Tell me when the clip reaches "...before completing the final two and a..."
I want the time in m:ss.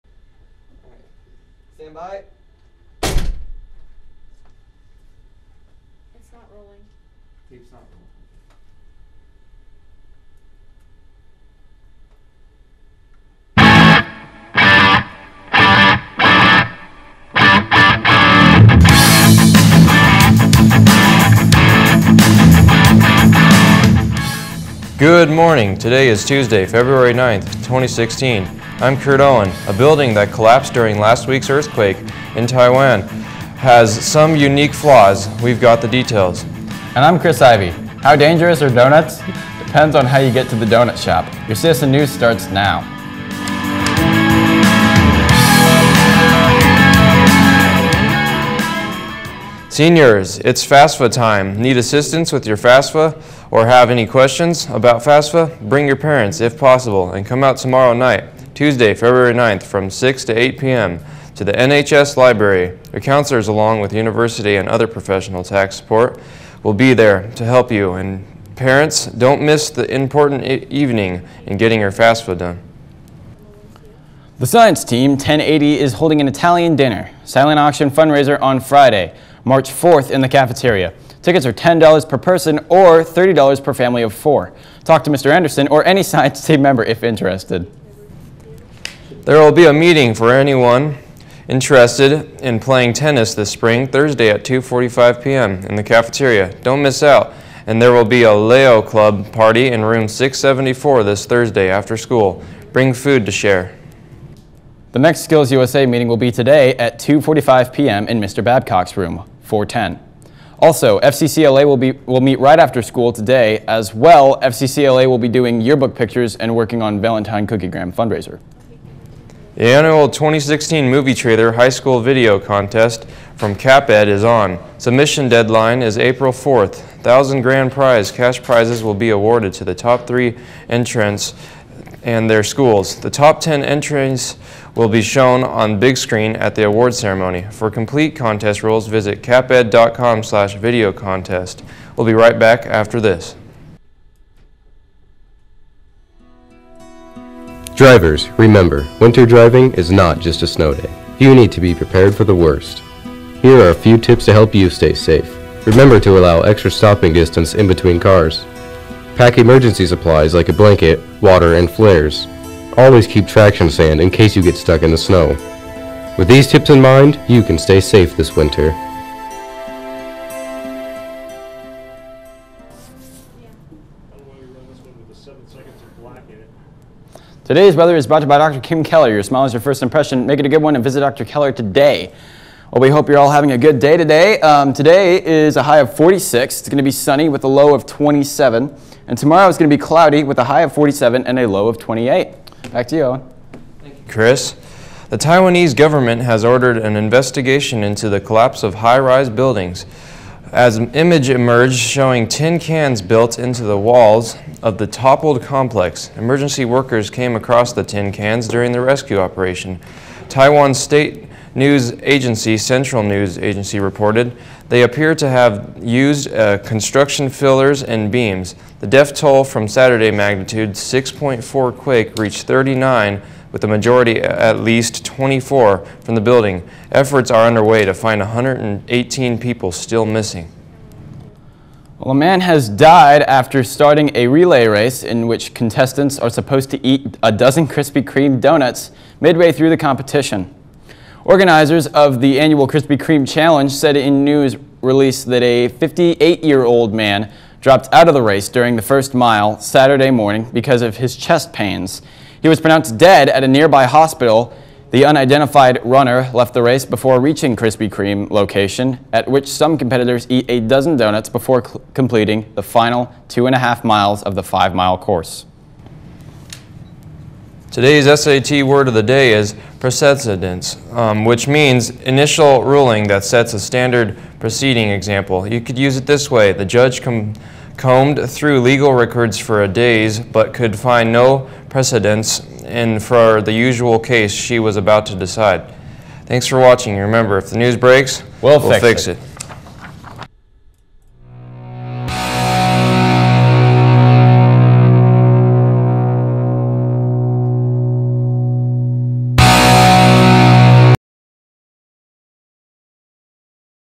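4:21.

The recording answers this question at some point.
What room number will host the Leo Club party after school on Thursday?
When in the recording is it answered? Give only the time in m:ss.
1:39.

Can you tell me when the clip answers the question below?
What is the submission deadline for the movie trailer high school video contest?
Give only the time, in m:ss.
2:05.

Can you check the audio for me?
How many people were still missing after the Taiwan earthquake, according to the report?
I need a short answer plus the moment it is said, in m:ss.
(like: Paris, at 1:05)
118, at 3:48.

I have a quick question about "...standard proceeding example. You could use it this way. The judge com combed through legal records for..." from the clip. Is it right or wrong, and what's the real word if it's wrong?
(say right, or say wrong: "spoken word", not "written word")
right.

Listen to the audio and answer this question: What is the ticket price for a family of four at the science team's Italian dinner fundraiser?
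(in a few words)
$30.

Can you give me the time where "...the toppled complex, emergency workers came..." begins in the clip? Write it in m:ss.
3:24.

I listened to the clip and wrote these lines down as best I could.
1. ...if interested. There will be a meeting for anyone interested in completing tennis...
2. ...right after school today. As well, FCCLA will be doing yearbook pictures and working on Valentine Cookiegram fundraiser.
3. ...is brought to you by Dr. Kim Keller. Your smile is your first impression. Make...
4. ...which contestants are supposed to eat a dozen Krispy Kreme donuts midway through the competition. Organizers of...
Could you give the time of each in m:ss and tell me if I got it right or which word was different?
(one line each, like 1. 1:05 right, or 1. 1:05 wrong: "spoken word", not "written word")
1. 1:26 wrong: "playing", not "completing"
2. 1:52 right
3. 2:57 right
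4. 3:55 right.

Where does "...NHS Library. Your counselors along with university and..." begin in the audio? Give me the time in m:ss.
1:01.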